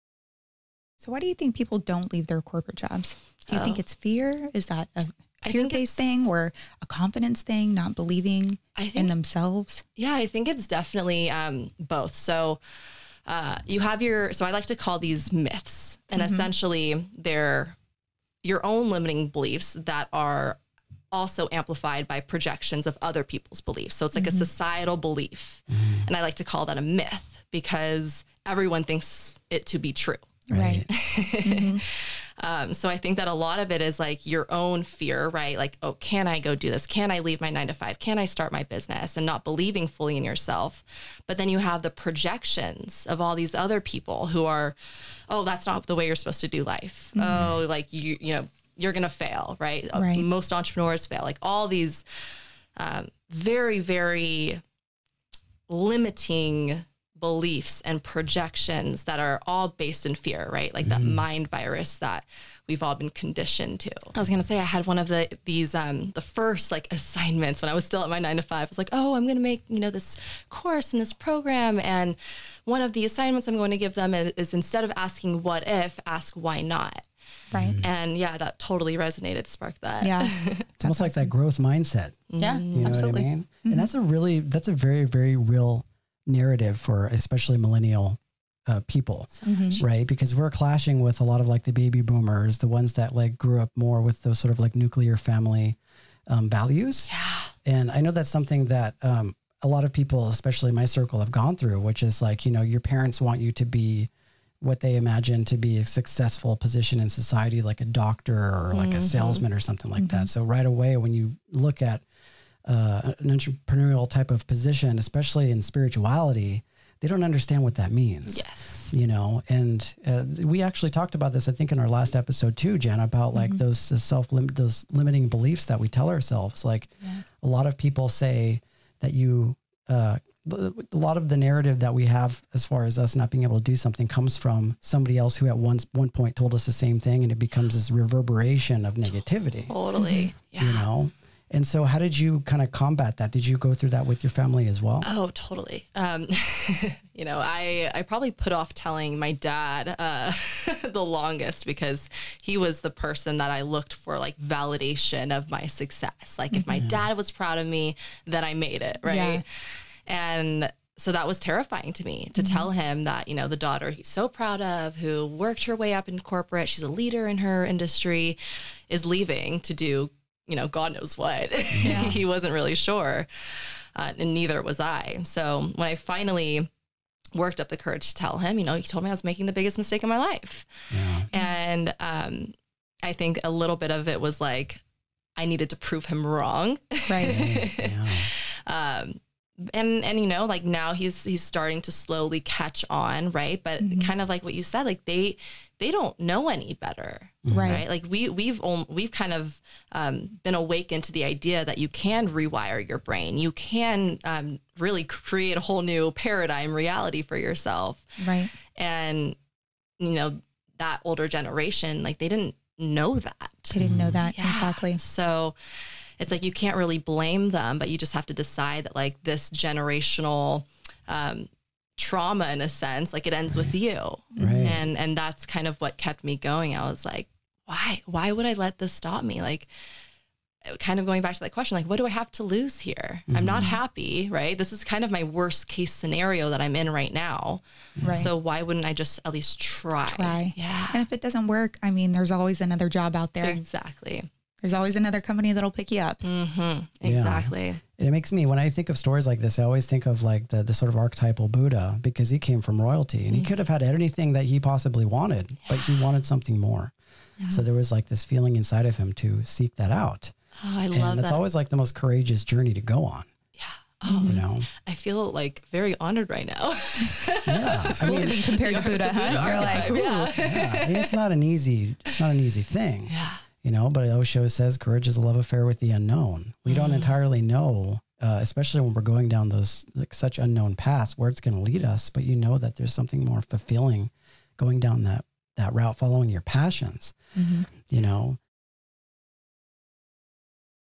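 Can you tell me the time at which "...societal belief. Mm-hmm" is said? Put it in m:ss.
0:24.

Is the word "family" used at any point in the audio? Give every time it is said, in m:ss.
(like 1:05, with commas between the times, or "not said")
1:35, 2:24.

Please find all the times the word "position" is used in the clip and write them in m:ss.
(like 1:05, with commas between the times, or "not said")
1:46, 1:54.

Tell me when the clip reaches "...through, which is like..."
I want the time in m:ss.
1:41.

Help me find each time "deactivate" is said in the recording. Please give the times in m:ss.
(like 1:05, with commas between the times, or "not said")
not said.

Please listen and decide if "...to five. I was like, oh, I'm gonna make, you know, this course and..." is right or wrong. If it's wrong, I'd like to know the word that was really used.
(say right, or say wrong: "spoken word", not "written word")
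right.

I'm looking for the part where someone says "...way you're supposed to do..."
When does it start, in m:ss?
0:45.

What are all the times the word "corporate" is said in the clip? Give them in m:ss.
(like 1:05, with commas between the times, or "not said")
0:02, 2:46.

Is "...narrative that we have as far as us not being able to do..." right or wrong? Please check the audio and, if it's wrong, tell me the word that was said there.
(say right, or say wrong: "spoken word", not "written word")
right.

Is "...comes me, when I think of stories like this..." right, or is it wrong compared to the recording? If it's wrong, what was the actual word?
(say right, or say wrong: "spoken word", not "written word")
wrong: "makes", not "comes".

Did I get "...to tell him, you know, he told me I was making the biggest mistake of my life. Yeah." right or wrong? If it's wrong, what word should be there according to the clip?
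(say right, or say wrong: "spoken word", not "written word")
right.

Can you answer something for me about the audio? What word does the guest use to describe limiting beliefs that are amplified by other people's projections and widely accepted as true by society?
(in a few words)
myths.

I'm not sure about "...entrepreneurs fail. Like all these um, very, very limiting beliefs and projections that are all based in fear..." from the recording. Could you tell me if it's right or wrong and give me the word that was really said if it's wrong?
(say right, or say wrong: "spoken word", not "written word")
right.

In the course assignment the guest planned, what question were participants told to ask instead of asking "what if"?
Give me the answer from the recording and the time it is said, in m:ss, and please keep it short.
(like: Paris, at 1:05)
why not, at 1:16.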